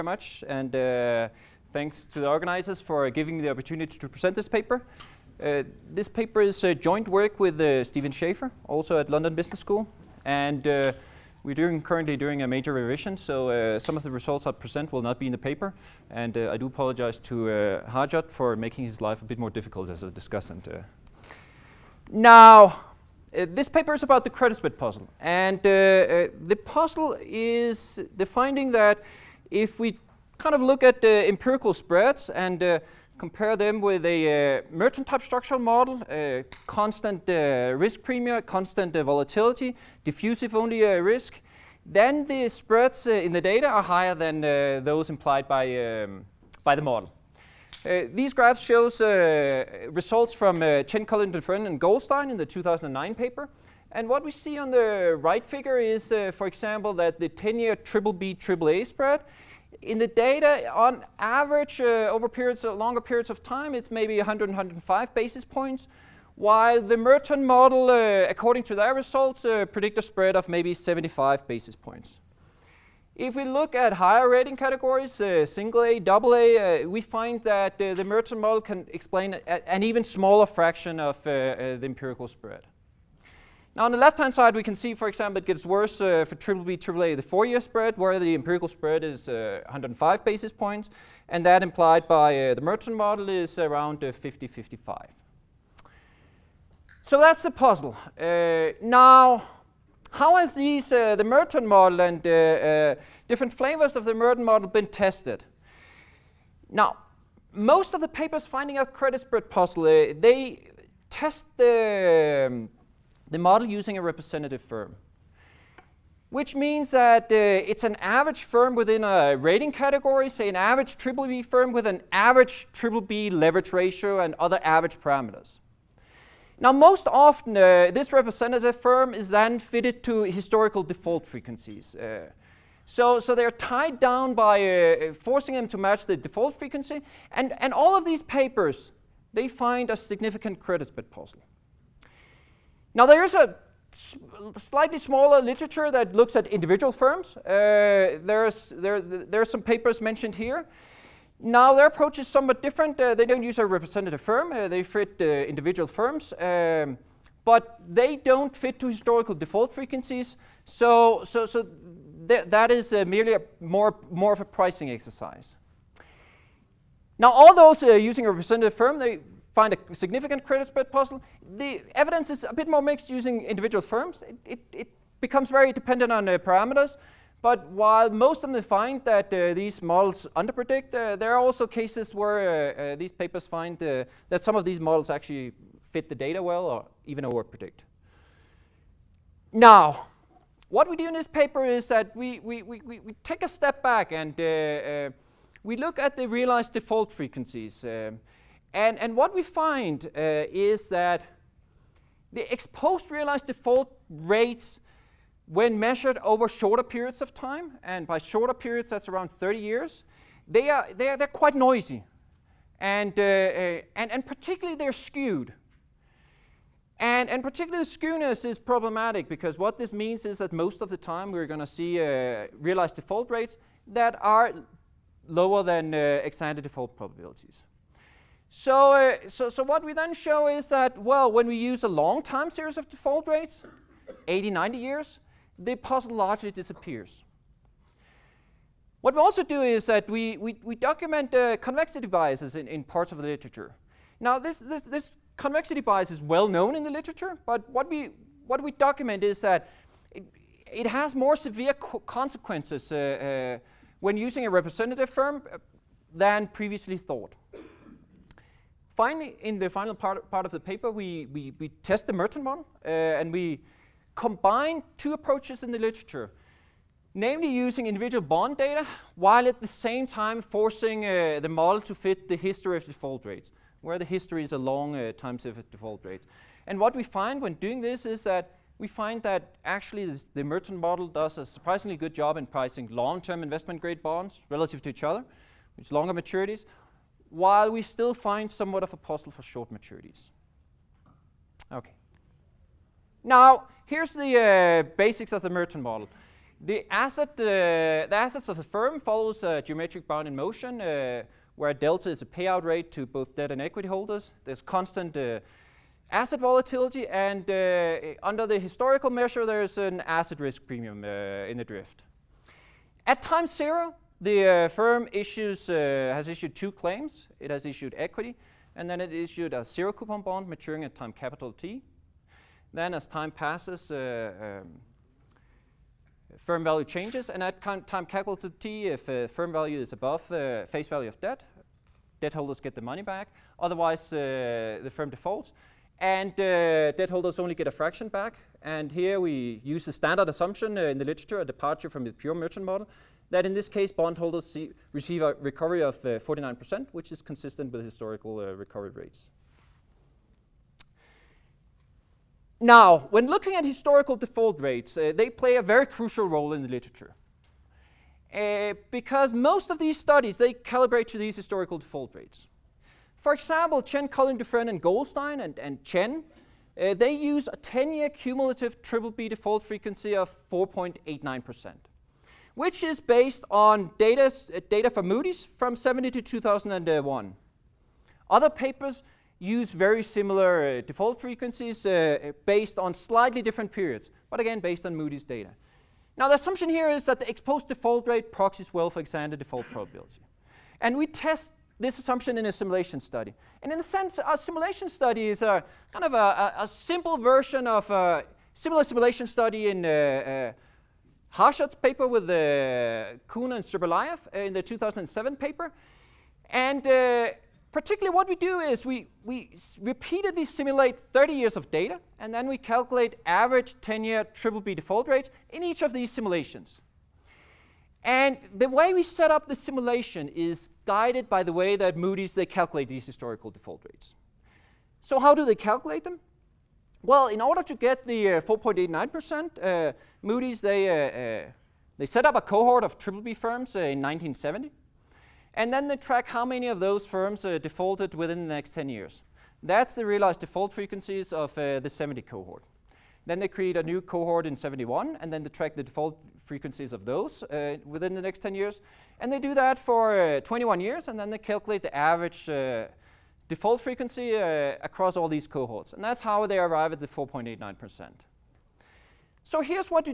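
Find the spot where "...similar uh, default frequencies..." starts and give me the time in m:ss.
6:20.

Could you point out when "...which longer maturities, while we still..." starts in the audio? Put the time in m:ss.
4:45.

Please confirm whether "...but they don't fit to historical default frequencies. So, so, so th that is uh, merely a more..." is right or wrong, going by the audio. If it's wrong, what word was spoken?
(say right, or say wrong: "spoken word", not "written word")
right.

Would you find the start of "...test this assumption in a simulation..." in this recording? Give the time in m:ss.
6:31.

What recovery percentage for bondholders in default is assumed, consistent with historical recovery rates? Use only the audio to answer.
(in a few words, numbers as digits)
49%.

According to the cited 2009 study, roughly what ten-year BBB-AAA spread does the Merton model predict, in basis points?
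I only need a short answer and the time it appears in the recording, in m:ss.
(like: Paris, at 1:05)
75, at 1:10.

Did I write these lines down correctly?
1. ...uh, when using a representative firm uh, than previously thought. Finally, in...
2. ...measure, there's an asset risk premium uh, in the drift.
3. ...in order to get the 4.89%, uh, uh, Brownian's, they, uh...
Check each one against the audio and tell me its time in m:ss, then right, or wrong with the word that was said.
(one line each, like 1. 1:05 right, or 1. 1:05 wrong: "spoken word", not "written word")
1. 4:12 right
2. 5:09 right
3. 7:07 wrong: "Moody", not "Brownian".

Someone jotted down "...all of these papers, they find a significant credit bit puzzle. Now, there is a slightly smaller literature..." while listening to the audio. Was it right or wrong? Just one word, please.
right.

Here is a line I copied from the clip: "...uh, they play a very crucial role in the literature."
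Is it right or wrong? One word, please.
right.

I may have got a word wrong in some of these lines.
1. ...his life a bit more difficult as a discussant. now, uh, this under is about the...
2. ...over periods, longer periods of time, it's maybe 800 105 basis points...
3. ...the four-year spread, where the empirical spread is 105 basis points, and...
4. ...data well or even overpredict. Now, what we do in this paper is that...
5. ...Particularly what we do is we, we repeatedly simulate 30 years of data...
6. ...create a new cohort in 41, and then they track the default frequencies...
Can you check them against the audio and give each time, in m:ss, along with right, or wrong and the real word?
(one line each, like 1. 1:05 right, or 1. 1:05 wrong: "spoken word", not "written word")
1. 0:18 wrong: "paper", not "under"
2. 1:02 wrong: "100", not "800"
3. 1:27 right
4. 3:06 right
5. 6:47 right
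6. 7:23 wrong: "71", not "41".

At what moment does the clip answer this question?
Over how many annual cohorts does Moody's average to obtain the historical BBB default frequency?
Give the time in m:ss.
7:30.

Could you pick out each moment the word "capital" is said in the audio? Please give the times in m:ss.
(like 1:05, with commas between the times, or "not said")
5:21, 5:28.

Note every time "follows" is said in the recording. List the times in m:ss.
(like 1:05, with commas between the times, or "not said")
4:59.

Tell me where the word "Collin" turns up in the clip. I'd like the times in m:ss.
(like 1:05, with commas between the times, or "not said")
0:51, 6:04.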